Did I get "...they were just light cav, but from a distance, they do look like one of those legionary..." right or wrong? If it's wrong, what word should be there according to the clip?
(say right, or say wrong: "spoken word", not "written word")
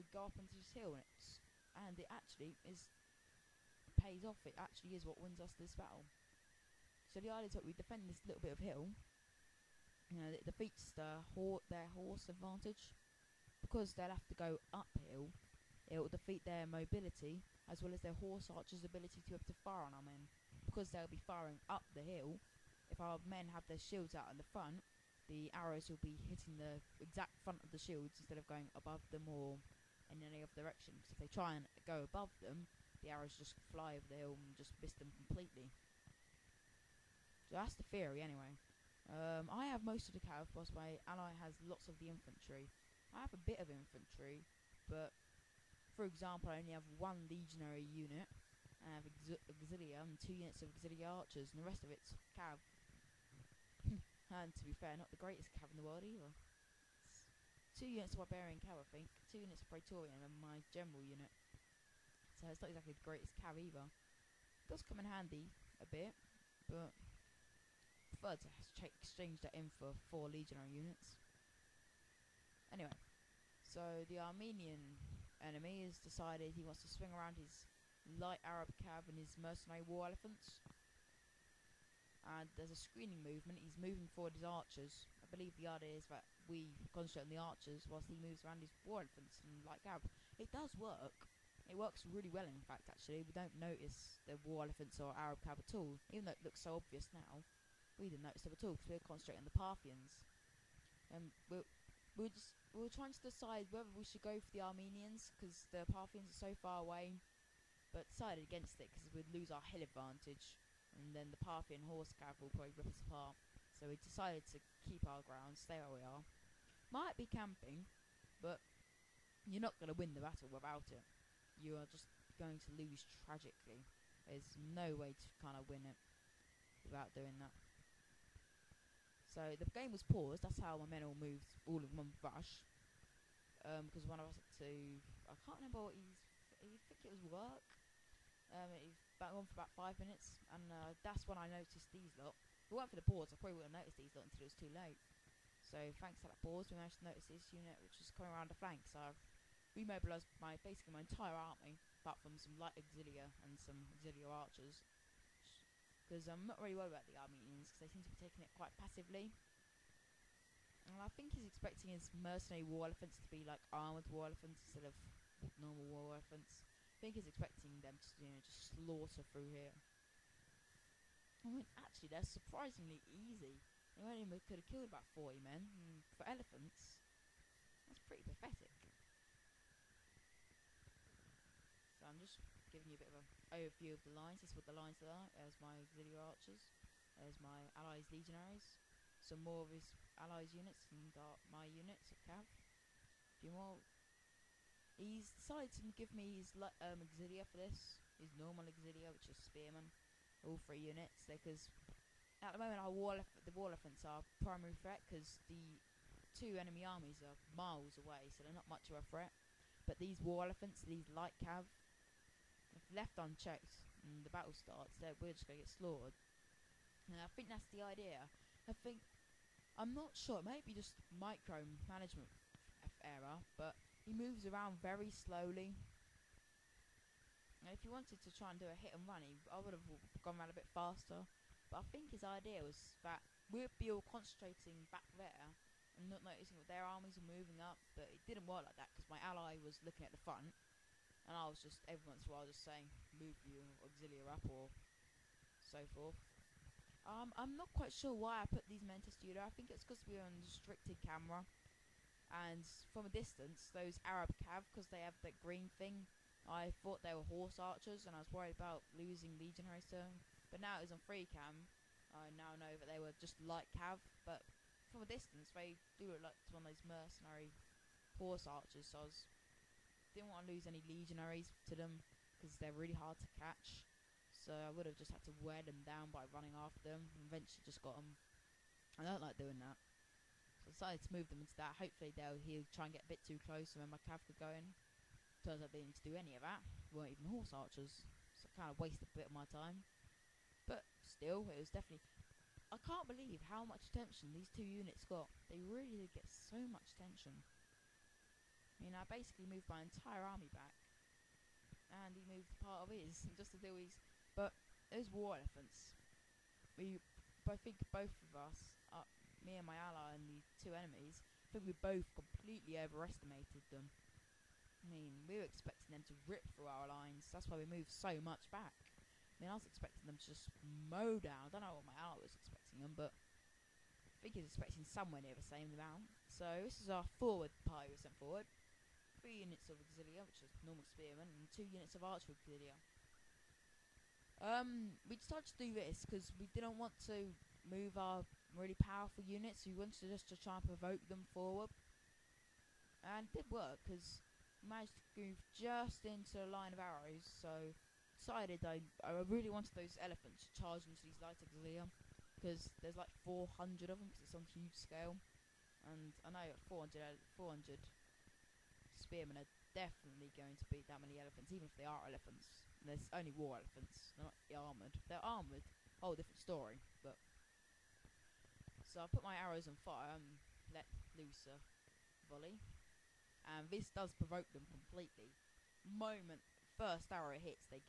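wrong: "mercenary", not "legionary".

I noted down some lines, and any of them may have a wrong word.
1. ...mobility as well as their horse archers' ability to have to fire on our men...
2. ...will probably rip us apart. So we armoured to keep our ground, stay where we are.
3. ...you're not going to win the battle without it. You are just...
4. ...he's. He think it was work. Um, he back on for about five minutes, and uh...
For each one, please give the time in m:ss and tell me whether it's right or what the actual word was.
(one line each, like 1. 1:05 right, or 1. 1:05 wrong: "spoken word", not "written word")
1. 0:16 right
2. 1:52 wrong: "decided", not "armoured"
3. 1:59 right
4. 2:15 right.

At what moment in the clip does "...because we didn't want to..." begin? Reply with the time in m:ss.
5:36.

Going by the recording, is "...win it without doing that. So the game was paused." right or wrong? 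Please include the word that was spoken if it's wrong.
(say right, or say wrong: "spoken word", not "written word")
right.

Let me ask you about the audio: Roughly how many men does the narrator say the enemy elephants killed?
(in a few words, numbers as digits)
40.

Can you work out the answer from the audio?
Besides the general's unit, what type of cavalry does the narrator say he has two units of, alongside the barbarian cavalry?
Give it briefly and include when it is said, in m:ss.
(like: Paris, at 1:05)
Praetorian, at 0:59.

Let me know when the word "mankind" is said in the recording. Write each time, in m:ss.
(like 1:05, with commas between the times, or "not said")
not said.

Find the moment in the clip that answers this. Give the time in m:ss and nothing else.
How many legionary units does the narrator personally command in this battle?
0:46.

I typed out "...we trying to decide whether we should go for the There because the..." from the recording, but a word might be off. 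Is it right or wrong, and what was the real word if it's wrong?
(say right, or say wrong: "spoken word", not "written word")
wrong: "Armenians", not "There".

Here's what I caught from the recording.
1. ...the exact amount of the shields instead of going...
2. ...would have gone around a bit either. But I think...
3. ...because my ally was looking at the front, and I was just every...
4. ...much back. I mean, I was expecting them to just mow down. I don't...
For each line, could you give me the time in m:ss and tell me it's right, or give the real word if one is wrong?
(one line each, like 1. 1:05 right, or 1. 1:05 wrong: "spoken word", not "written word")
1. 0:26 wrong: "front", not "amount"
2. 3:49 wrong: "faster", not "either"
3. 3:58 right
4. 5:18 right.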